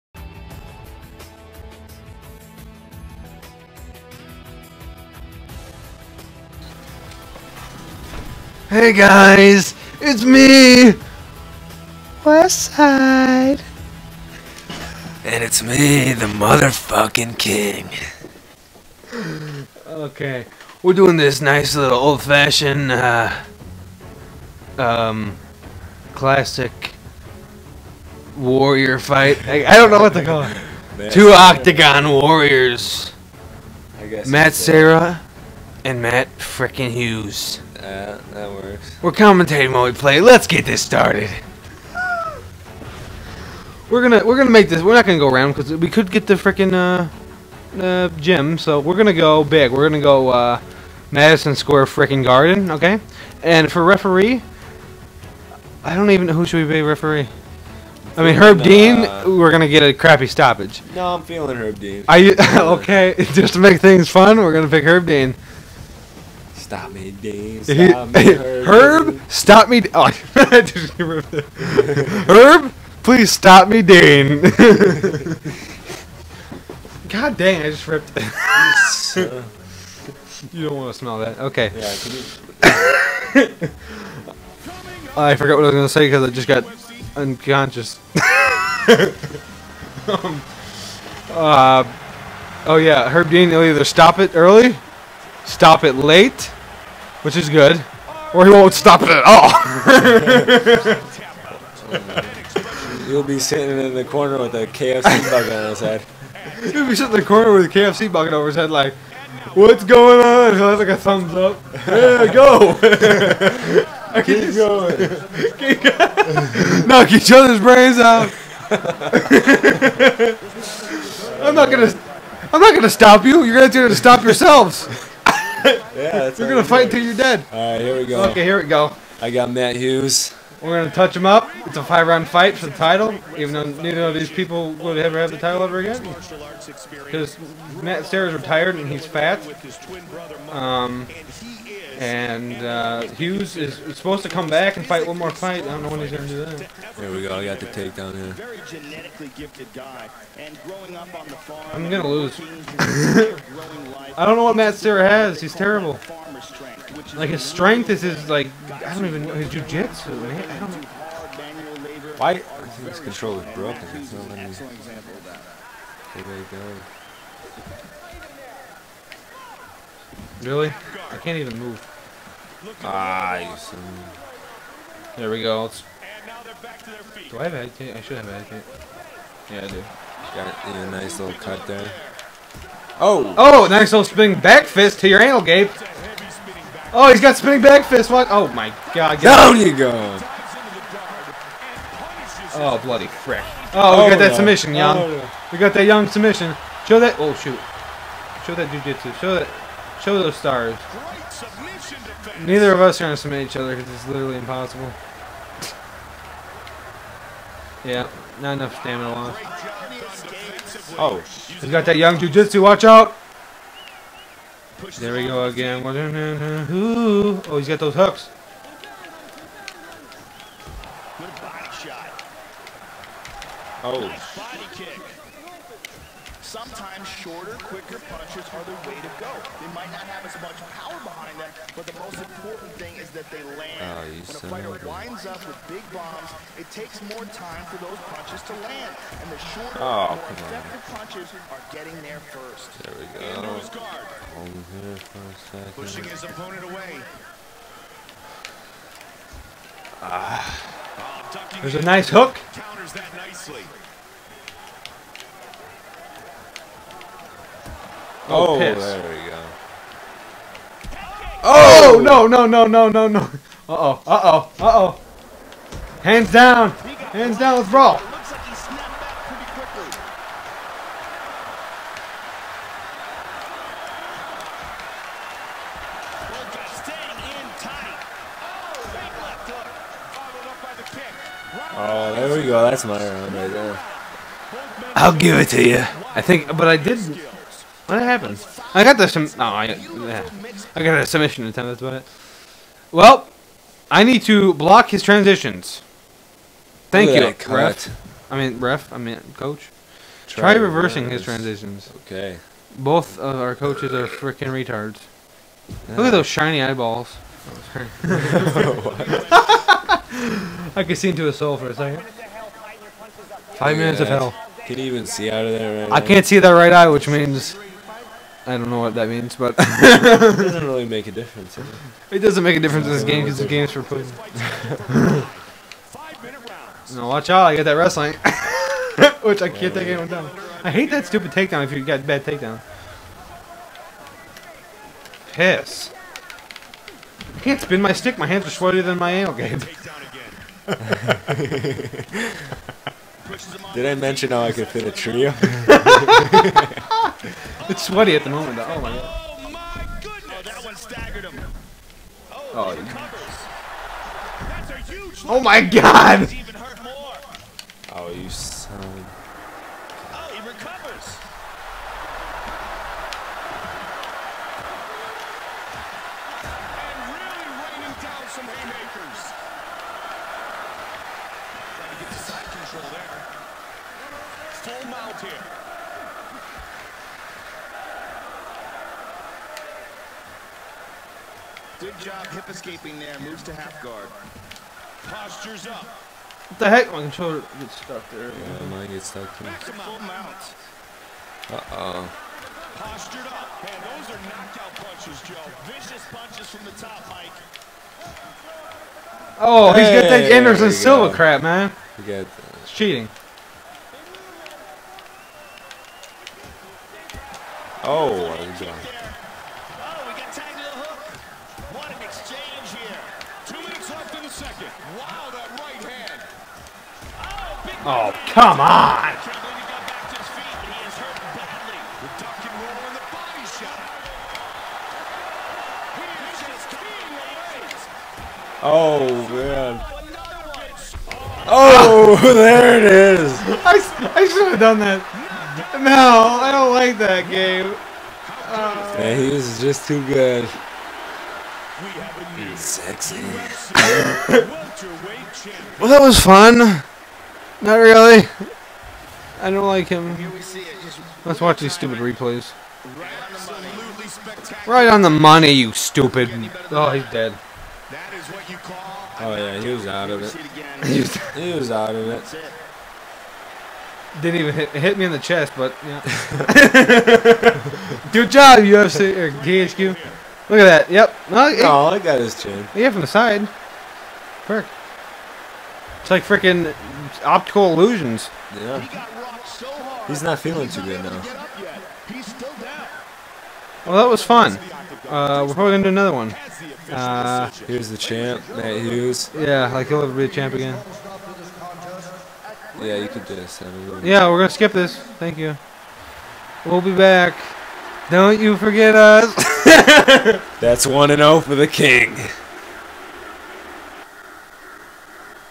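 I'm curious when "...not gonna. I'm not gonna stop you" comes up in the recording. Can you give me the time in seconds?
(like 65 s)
121 s.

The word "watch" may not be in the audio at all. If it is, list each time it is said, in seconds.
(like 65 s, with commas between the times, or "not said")
212 s, 327 s, 451 s.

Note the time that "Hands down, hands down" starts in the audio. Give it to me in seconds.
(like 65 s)
266 s.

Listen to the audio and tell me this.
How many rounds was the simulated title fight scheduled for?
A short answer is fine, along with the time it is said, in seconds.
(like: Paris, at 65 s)
5, at 131 s.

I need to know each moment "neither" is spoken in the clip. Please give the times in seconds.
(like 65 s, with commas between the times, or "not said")
133 s, 202 s.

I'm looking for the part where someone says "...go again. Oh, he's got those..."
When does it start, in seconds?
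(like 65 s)
215 s.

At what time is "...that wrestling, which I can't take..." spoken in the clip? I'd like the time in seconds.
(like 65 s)
327 s.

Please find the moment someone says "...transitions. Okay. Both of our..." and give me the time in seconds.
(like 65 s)
301 s.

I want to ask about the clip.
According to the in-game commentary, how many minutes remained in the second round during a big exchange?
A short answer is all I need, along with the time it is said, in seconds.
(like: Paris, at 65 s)
2, at 413 s.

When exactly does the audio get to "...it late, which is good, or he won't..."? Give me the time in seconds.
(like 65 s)
95 s.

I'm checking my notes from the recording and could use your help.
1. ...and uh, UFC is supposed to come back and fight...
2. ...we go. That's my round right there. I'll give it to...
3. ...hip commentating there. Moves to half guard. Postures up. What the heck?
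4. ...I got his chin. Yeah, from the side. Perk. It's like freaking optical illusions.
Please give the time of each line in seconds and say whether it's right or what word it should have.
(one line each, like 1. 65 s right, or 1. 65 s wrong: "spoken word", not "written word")
1. 142 s wrong: "Hughes", not "UFC"
2. 282 s right
3. 382 s wrong: "escaping", not "commentating"
4. 471 s right.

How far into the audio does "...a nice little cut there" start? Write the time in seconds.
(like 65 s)
180 s.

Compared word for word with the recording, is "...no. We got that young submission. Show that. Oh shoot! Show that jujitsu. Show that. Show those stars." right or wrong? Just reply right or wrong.
right.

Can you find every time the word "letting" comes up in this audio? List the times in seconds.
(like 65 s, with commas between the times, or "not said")
164 s.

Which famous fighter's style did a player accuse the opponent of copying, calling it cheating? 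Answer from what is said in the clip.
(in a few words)
Anderson Silva.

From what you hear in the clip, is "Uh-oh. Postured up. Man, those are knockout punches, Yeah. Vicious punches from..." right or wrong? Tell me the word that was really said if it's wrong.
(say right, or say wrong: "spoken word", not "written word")
wrong: "Joe", not "Yeah".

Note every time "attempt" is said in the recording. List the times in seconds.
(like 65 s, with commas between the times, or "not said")
291 s.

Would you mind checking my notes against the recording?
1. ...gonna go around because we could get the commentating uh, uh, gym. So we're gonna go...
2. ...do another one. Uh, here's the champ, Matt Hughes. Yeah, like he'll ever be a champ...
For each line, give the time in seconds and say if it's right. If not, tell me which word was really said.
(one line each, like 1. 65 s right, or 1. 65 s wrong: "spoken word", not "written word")
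1. 45 s wrong: "freaking", not "commentating"
2. 485 s right.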